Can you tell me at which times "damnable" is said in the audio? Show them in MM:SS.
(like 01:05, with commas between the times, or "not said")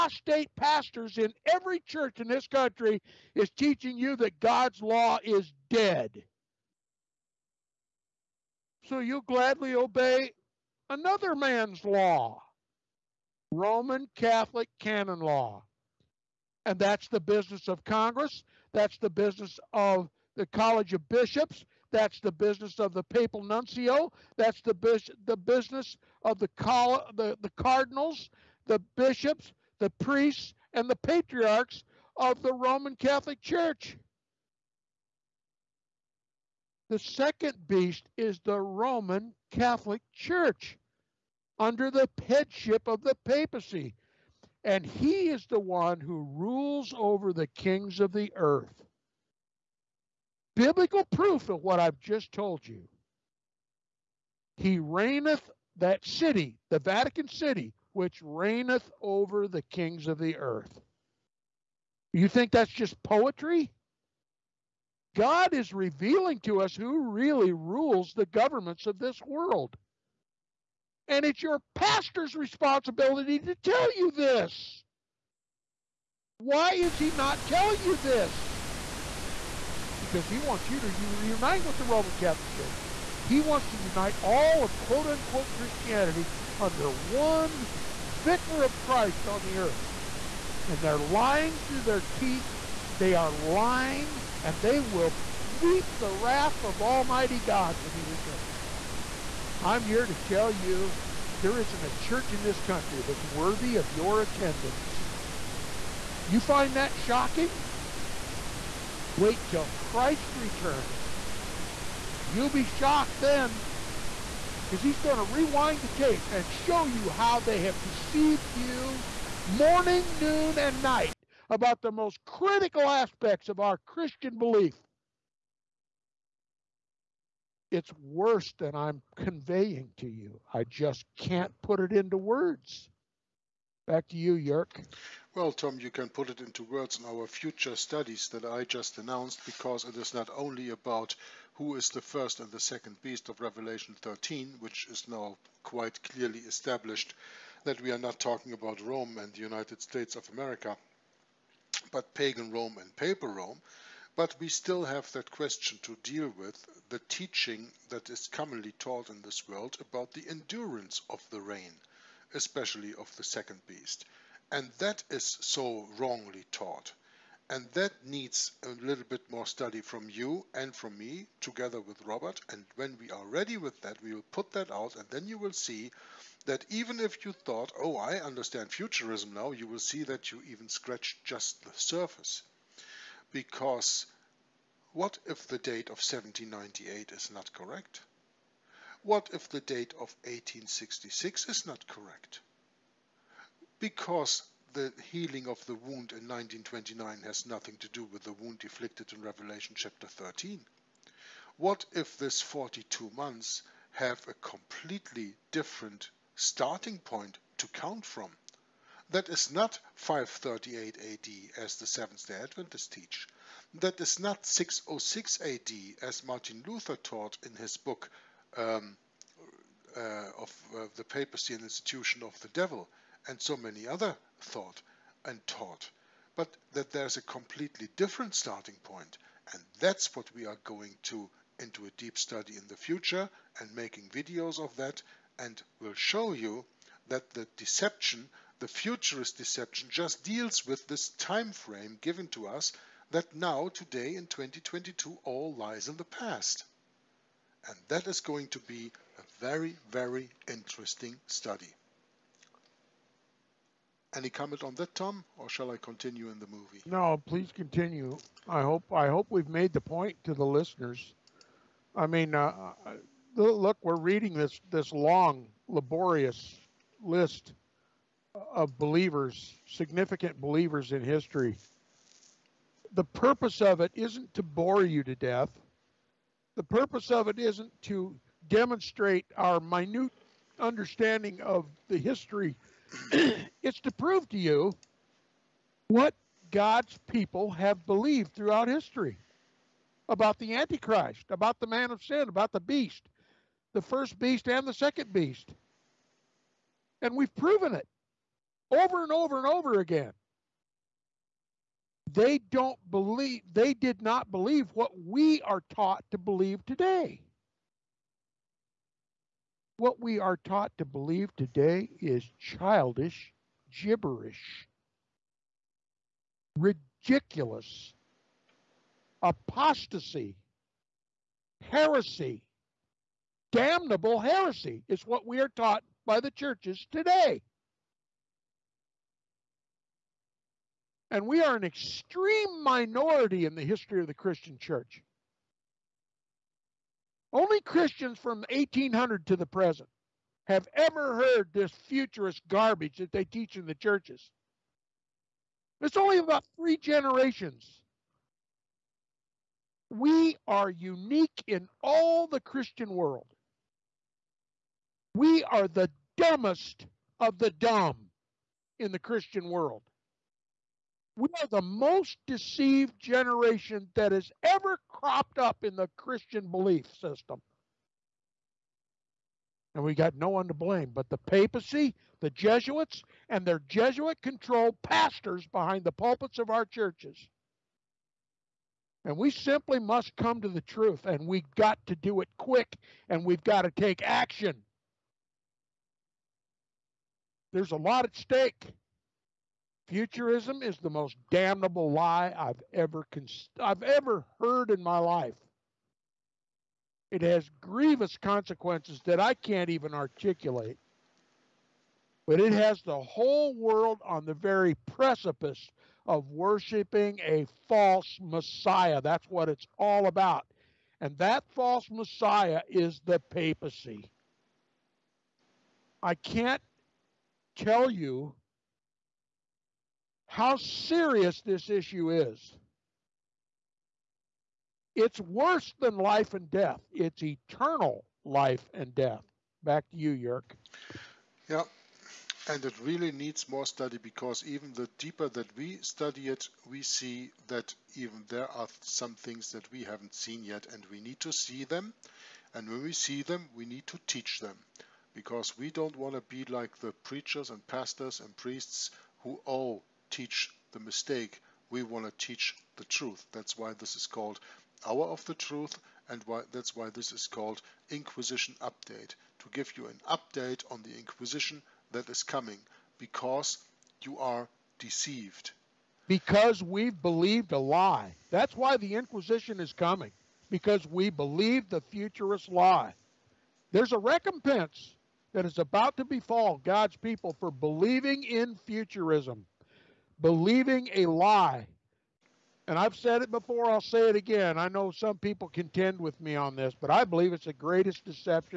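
05:23, 06:31.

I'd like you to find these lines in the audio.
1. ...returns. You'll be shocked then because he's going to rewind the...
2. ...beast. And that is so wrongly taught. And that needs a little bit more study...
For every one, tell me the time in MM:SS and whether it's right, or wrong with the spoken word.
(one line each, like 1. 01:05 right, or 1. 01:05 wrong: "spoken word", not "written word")
1. 01:50 right
2. 02:43 right.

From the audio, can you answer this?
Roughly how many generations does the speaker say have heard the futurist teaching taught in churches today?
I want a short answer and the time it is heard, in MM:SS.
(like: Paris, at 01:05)
3, at 05:46.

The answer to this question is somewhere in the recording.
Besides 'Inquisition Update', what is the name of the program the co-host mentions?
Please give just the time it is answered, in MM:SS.
07:34.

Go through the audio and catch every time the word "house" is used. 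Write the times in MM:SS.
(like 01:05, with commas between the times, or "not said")
not said.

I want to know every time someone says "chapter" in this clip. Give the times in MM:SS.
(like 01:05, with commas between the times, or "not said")
03:19.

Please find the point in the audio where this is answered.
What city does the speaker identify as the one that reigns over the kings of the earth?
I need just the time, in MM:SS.
00:56.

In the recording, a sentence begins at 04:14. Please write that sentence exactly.
Any comment on that, Tom, or shall I continue in the movie?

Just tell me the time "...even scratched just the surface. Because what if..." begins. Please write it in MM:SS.
03:00.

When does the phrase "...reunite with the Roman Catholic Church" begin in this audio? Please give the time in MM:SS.
01:21.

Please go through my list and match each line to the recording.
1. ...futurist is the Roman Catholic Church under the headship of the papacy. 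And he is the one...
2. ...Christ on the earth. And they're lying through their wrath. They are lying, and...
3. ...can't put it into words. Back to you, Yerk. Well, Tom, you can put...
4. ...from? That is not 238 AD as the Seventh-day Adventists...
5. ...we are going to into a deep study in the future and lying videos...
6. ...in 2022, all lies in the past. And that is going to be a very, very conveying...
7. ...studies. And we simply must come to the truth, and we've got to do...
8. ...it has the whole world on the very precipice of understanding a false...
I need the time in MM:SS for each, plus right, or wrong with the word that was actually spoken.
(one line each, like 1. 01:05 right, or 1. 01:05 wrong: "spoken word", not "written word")
1. 00:37 wrong: "beast", not "futurist"
2. 01:28 wrong: "teeth", not "wrath"
3. 02:11 right
4. 03:28 wrong: "538", not "238"
5. 03:50 wrong: "making", not "lying"
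6. 04:04 wrong: "interesting", not "conveying"
7. 06:16 wrong: "churches", not "studies"
8. 06:42 wrong: "worshiping", not "understanding".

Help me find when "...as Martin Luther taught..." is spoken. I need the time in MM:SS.
03:36.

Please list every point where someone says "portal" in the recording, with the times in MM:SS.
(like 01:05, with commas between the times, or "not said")
not said.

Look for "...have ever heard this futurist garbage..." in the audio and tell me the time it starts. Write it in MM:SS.
05:40.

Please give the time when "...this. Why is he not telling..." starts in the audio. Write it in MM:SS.
01:14.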